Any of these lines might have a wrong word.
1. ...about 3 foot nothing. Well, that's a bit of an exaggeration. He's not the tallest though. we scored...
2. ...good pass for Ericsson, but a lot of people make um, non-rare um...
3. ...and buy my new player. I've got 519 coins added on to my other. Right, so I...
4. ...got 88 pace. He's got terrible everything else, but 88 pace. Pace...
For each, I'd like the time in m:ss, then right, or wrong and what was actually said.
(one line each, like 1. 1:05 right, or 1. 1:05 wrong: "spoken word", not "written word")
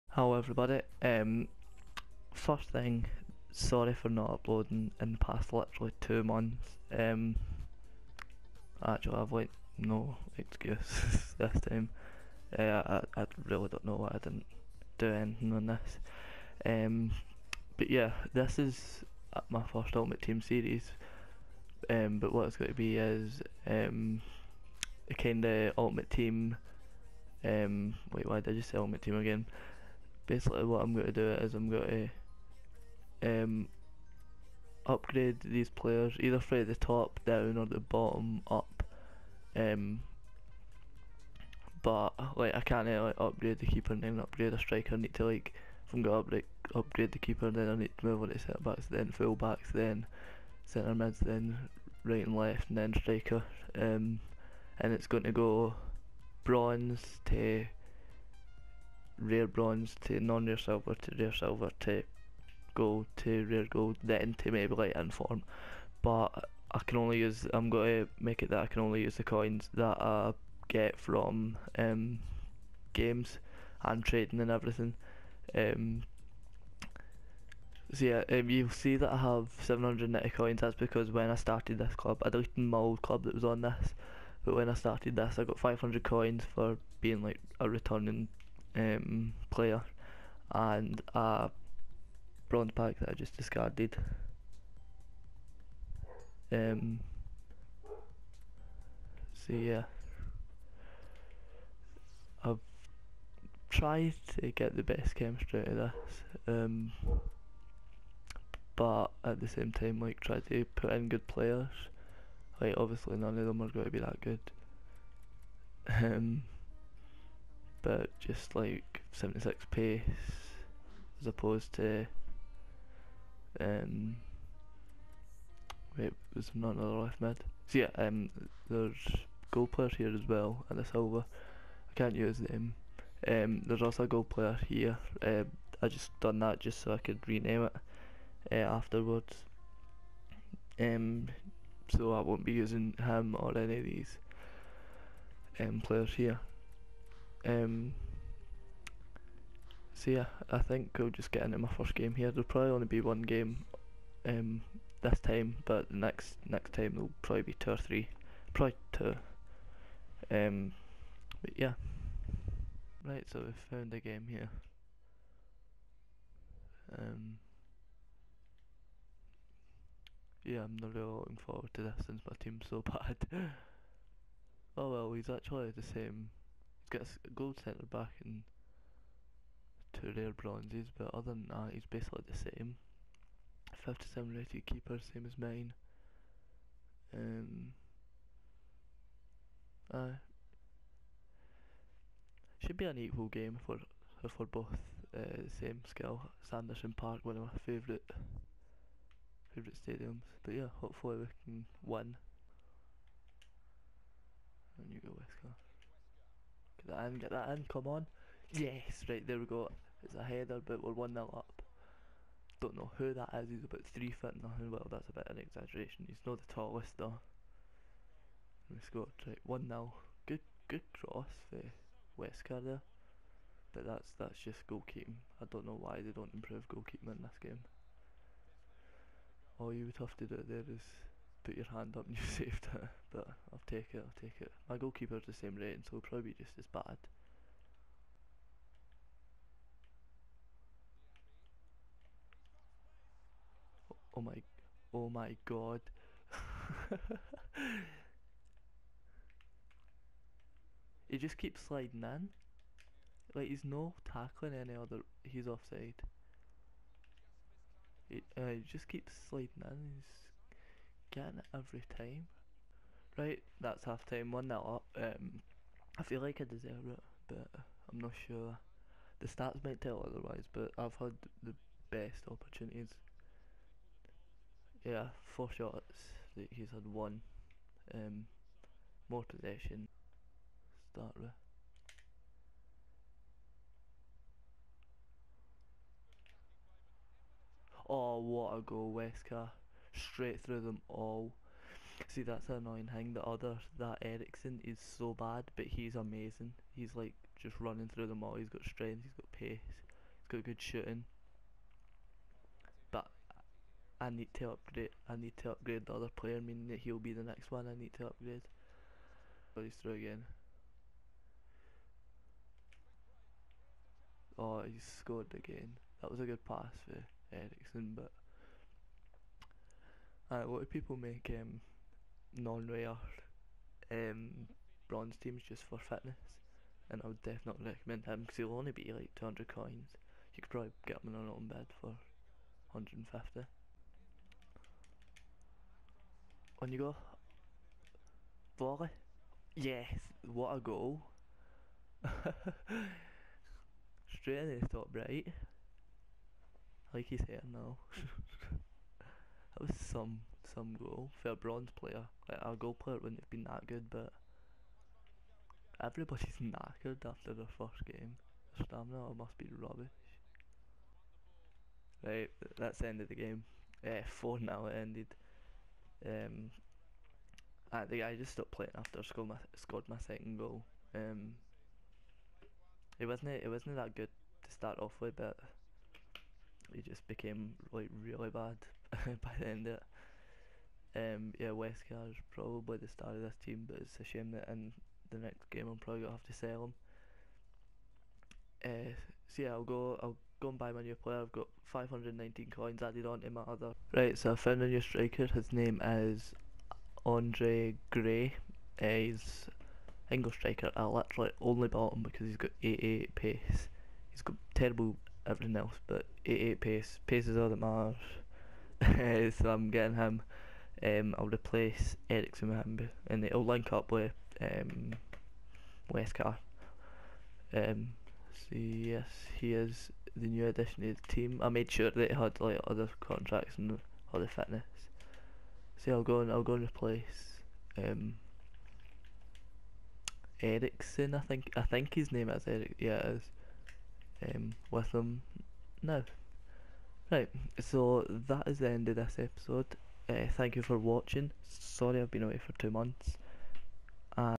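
1. 3:33 right
2. 5:16 right
3. 6:30 right
4. 6:42 right.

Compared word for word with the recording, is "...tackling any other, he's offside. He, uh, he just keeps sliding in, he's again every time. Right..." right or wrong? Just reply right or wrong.
right.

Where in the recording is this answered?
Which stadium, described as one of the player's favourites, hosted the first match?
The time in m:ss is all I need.
3:16.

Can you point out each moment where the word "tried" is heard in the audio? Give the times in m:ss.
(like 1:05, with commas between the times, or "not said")
1:43, 1:50.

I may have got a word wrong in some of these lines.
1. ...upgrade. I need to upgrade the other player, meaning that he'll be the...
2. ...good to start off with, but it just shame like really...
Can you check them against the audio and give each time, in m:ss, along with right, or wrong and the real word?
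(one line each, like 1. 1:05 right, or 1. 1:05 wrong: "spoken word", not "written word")
1. 5:04 right
2. 6:13 wrong: "became", not "shame".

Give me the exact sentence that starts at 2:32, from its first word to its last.
There'll probably only be one game um, this time, but the next next time there'll probably be two or three, probably two.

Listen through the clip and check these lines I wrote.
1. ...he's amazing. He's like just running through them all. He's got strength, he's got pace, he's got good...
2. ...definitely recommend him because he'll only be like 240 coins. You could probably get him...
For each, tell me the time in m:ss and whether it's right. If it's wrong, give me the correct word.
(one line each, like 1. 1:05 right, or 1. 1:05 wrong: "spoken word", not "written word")
1. 4:55 right
2. 5:27 wrong: "200", not "240".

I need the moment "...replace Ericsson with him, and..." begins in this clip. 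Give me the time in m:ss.
6:51.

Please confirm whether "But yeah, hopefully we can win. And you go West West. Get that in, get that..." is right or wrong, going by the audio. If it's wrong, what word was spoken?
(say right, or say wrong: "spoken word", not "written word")
wrong: "Coast", not "West".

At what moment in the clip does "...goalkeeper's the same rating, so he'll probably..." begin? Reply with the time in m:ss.
3:54.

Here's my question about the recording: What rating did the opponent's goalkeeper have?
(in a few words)
57.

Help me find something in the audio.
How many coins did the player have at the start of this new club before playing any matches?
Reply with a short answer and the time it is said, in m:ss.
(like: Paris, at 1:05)
790, at 1:19.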